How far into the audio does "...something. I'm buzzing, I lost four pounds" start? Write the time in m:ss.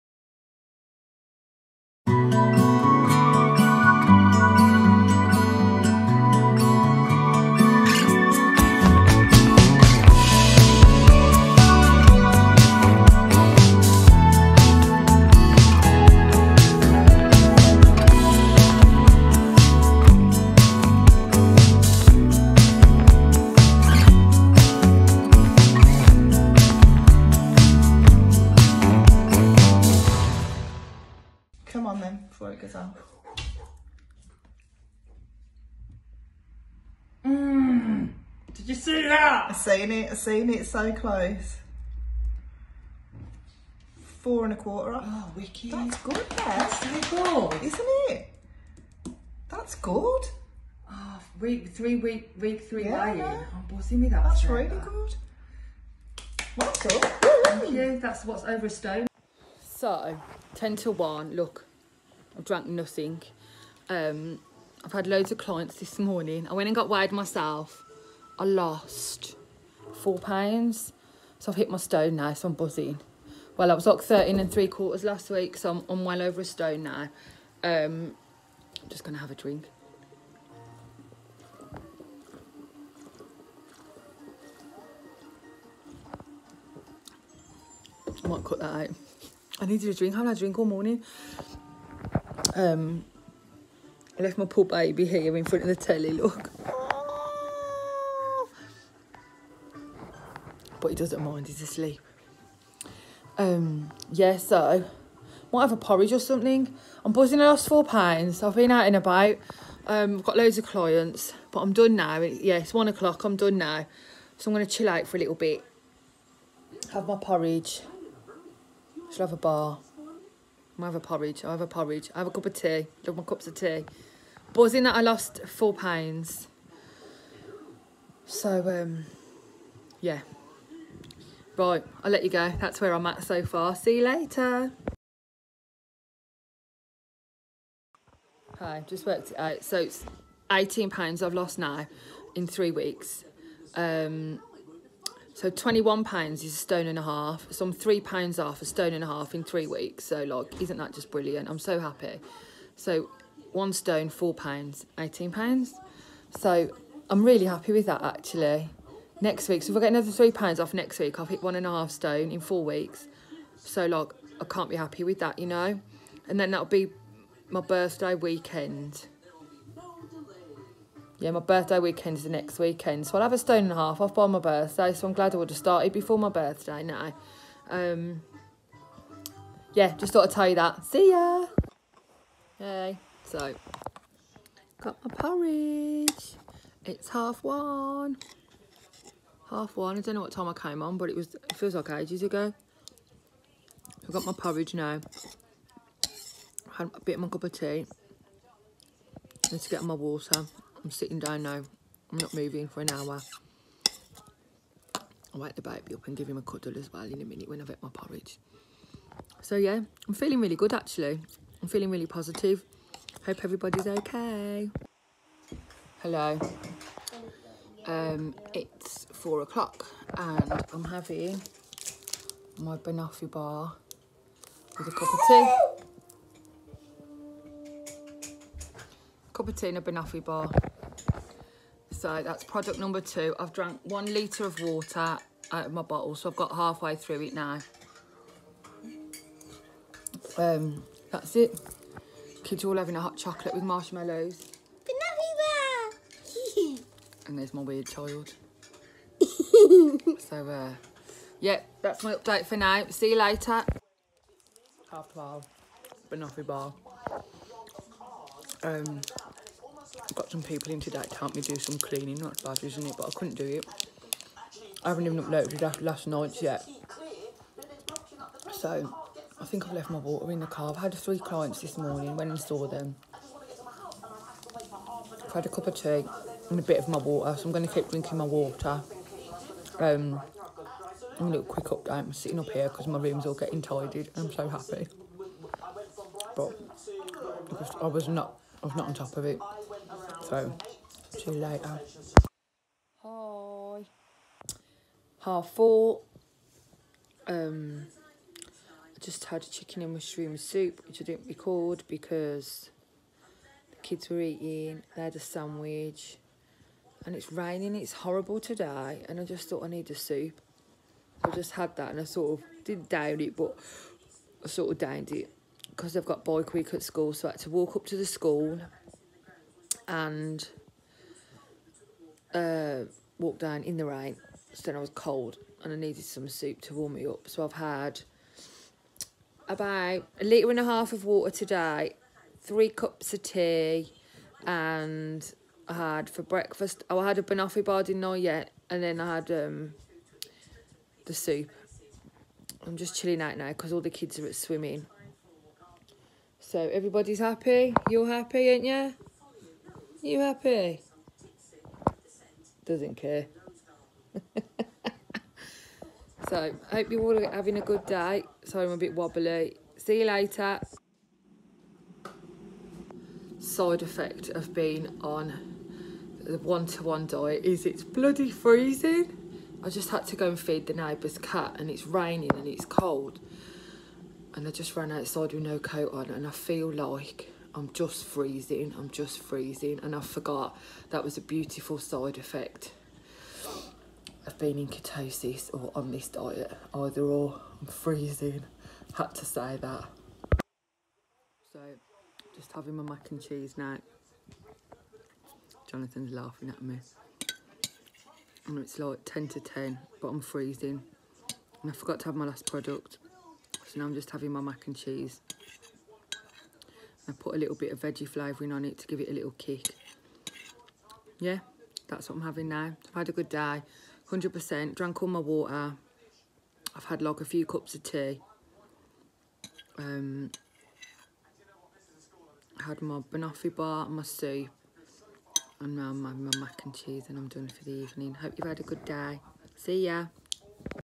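1:46.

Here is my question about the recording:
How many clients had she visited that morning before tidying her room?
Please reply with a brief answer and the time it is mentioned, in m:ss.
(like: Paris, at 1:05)
3, at 4:30.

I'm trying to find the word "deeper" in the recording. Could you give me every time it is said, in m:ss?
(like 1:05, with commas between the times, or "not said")
not said.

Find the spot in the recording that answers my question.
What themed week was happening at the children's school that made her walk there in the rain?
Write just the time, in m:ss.
5:16.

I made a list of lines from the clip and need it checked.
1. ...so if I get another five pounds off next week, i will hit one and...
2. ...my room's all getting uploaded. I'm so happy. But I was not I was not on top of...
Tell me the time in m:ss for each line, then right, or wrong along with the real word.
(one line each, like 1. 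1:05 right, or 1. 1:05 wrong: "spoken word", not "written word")
1. 2:39 wrong: "three", not "five"
2. 4:42 wrong: "tidied", not "uploaded".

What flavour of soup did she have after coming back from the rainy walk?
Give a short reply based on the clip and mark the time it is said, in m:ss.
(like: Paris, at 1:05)
chicken and mushroom, at 4:59.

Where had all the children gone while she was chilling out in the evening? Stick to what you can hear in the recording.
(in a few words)
swimming.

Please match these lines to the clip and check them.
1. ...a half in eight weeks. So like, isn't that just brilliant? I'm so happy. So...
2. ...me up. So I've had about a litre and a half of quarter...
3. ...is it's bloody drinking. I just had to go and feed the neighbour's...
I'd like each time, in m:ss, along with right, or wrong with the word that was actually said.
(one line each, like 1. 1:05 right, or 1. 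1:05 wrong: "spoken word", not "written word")
1. 2:29 wrong: "three", not "eight"
2. 5:26 wrong: "water", not "quarter"
3. 6:07 wrong: "freezing", not "drinking".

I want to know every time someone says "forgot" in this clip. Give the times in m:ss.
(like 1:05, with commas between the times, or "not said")
6:19, 6:41.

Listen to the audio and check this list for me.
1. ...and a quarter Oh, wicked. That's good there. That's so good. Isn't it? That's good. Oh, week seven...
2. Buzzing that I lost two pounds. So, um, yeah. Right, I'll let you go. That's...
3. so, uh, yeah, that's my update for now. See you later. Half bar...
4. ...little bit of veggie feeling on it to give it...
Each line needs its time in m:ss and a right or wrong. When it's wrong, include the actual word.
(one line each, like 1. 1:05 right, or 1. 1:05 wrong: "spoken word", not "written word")
1. 0:44 wrong: "three", not "seven"
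2. 2:04 wrong: "four", not "two"
3. 4:10 right
4. 6:47 wrong: "flavouring", not "feeling".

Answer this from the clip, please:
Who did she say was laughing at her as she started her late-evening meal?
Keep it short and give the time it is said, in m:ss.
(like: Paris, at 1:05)
Jonathan, at 6:35.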